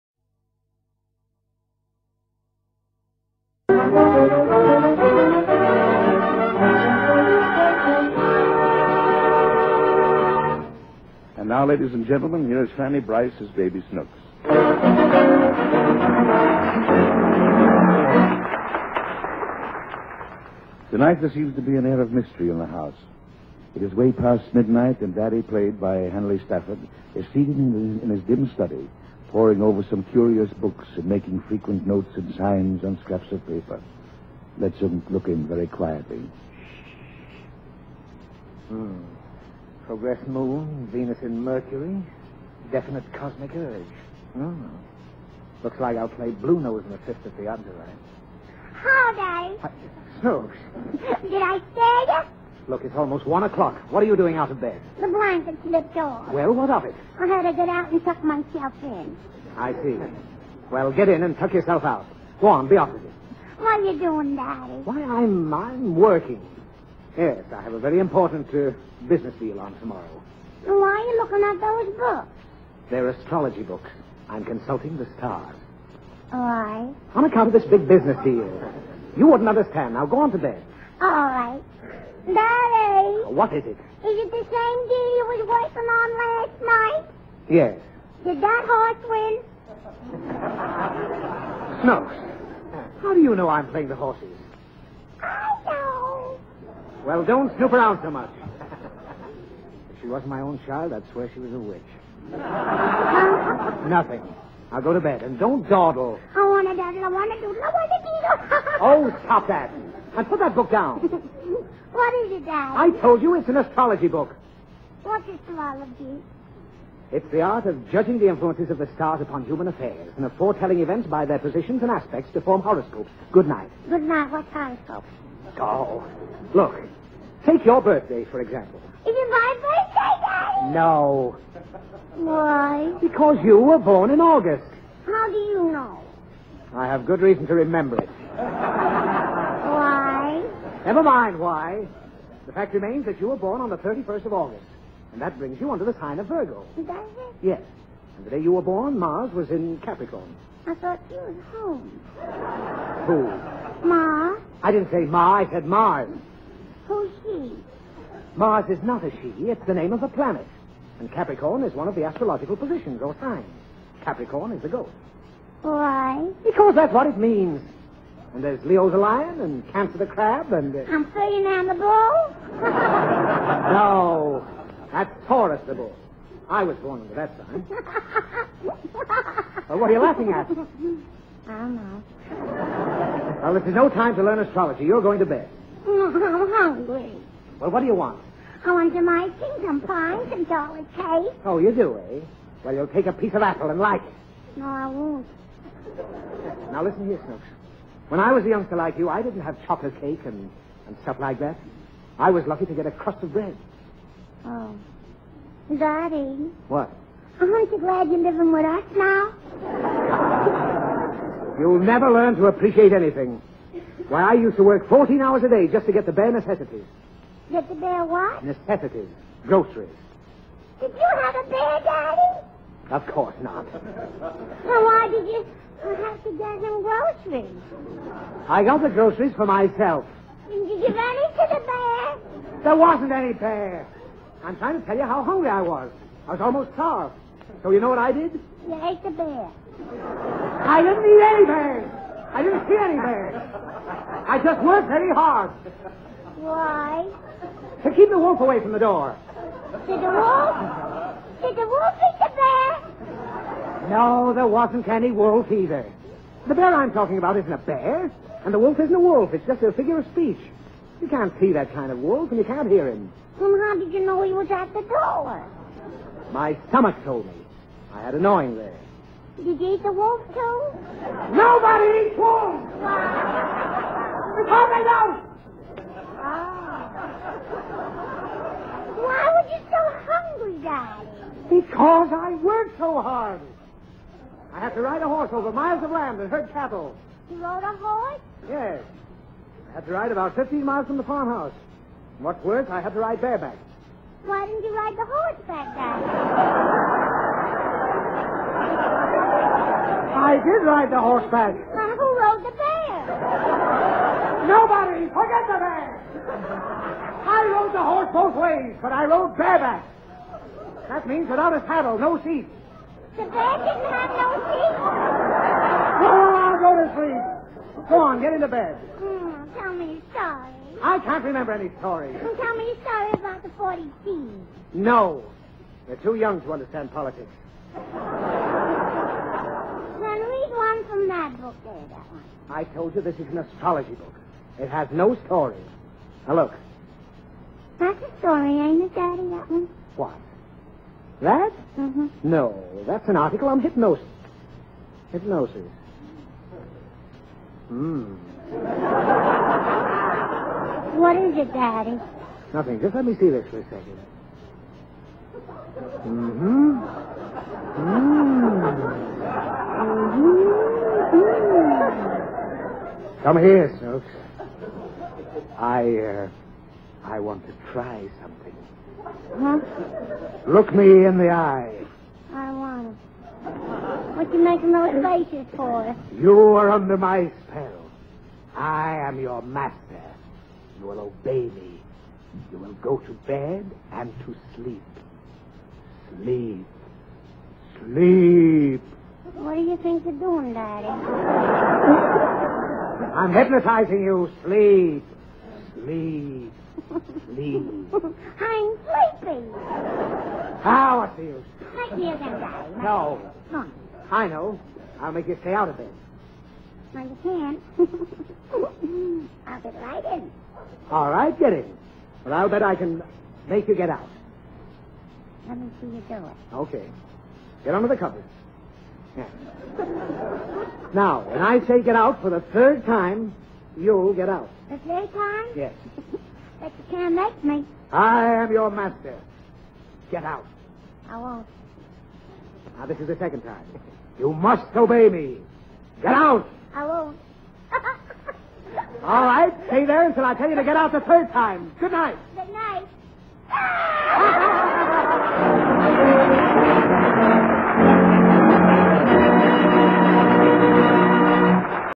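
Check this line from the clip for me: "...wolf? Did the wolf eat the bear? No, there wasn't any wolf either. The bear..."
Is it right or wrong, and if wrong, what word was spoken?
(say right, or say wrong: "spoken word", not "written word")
right.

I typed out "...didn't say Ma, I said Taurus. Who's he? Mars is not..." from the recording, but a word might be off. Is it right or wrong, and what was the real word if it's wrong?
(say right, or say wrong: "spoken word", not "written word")
wrong: "Mars", not "Taurus".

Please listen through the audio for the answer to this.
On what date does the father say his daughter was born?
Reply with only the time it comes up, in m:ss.
2:23.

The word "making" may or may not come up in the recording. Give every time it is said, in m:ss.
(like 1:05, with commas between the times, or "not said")
0:31, 6:14.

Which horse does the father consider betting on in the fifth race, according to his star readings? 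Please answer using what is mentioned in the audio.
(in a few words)
Blue Nose.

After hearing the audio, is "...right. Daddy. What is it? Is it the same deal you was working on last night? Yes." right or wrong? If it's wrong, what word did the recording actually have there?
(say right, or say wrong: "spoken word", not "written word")
right.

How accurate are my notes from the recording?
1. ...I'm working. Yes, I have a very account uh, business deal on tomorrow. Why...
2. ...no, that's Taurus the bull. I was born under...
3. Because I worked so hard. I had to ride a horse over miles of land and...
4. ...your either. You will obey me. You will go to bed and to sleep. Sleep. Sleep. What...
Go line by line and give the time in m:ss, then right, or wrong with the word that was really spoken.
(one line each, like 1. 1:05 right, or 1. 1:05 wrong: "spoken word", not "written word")
1. 1:05 wrong: "important", not "account"
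2. 2:53 right
3. 4:41 right
4. 6:19 wrong: "master", not "either".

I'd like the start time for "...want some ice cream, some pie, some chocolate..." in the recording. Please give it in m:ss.
3:08.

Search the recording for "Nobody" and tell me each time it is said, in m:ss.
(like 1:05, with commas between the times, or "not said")
4:31, 5:04.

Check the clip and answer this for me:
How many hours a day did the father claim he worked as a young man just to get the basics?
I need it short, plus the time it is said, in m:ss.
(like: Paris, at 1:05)
14, at 3:34.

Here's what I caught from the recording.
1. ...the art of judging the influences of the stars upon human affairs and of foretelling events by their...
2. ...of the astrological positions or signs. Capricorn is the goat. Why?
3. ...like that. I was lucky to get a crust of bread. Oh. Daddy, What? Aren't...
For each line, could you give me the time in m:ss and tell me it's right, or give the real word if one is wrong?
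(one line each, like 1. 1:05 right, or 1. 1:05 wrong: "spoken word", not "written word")
1. 1:57 right
2. 2:41 right
3. 3:21 right.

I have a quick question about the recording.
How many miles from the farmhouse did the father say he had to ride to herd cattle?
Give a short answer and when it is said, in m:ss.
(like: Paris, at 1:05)
15, at 4:50.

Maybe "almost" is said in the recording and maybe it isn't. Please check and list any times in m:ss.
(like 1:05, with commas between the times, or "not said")
0:52, 3:56.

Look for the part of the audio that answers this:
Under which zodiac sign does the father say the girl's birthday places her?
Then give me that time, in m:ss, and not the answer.
2:26.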